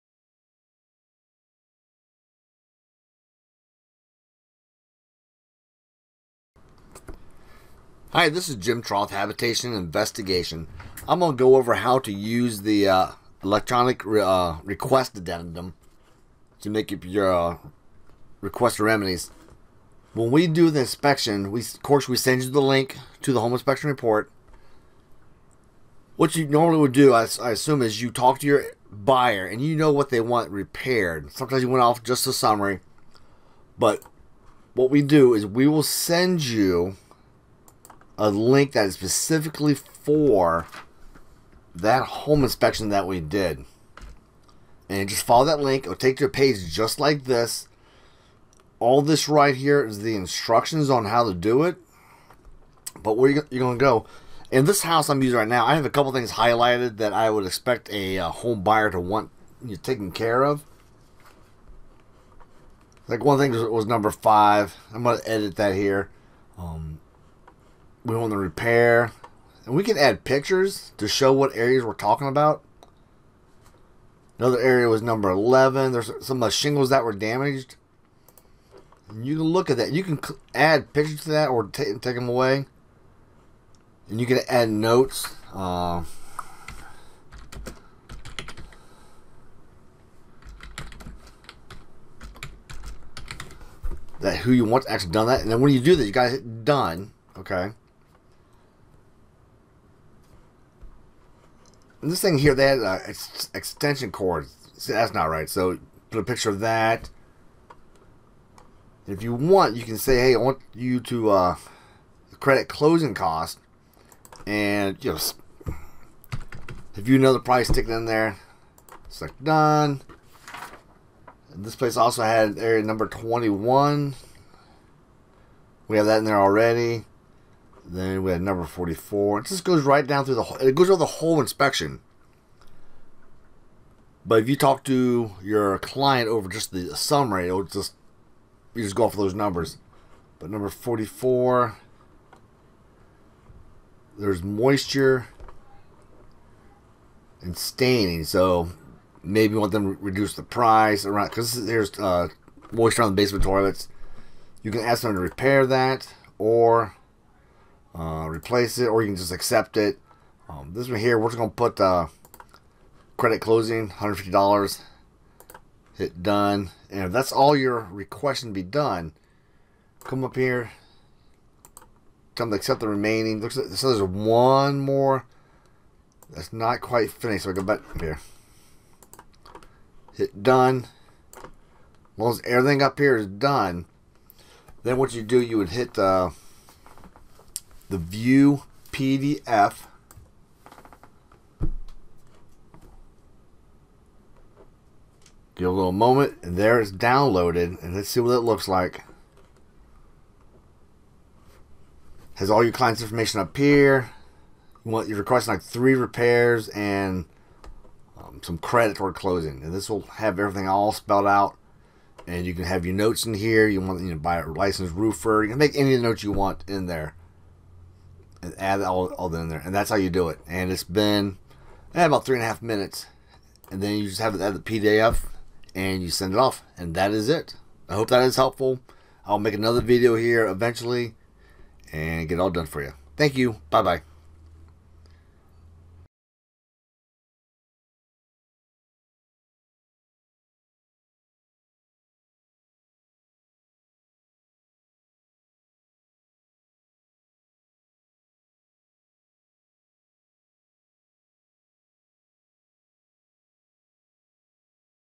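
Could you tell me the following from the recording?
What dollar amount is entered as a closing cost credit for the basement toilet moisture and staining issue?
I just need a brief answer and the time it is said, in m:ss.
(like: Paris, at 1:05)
$150, at 2:43.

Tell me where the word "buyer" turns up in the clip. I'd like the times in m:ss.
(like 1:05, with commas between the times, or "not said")
0:28, 0:58.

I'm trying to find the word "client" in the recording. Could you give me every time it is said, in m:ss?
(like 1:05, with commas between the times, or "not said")
2:15, 3:22.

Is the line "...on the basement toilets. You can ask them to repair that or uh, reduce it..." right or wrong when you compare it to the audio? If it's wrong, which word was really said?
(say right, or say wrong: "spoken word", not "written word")
wrong: "replace", not "reduce".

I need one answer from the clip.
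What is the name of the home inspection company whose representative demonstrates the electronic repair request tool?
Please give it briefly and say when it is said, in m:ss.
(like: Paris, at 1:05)
Habitation Investigation, at 0:09.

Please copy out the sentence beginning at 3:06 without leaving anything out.
Uh, the view PDF Give a little moment, and there it's downloaded, and let's see what it looks like.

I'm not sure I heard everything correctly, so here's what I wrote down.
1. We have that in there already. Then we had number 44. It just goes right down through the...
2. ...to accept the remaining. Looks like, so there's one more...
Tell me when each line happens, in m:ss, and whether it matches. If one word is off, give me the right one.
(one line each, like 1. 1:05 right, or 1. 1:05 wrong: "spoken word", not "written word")
1. 2:05 right
2. 2:52 right.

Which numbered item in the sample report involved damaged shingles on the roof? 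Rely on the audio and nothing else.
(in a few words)
11.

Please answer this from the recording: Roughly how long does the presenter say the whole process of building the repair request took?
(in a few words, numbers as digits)
three and a half minutes.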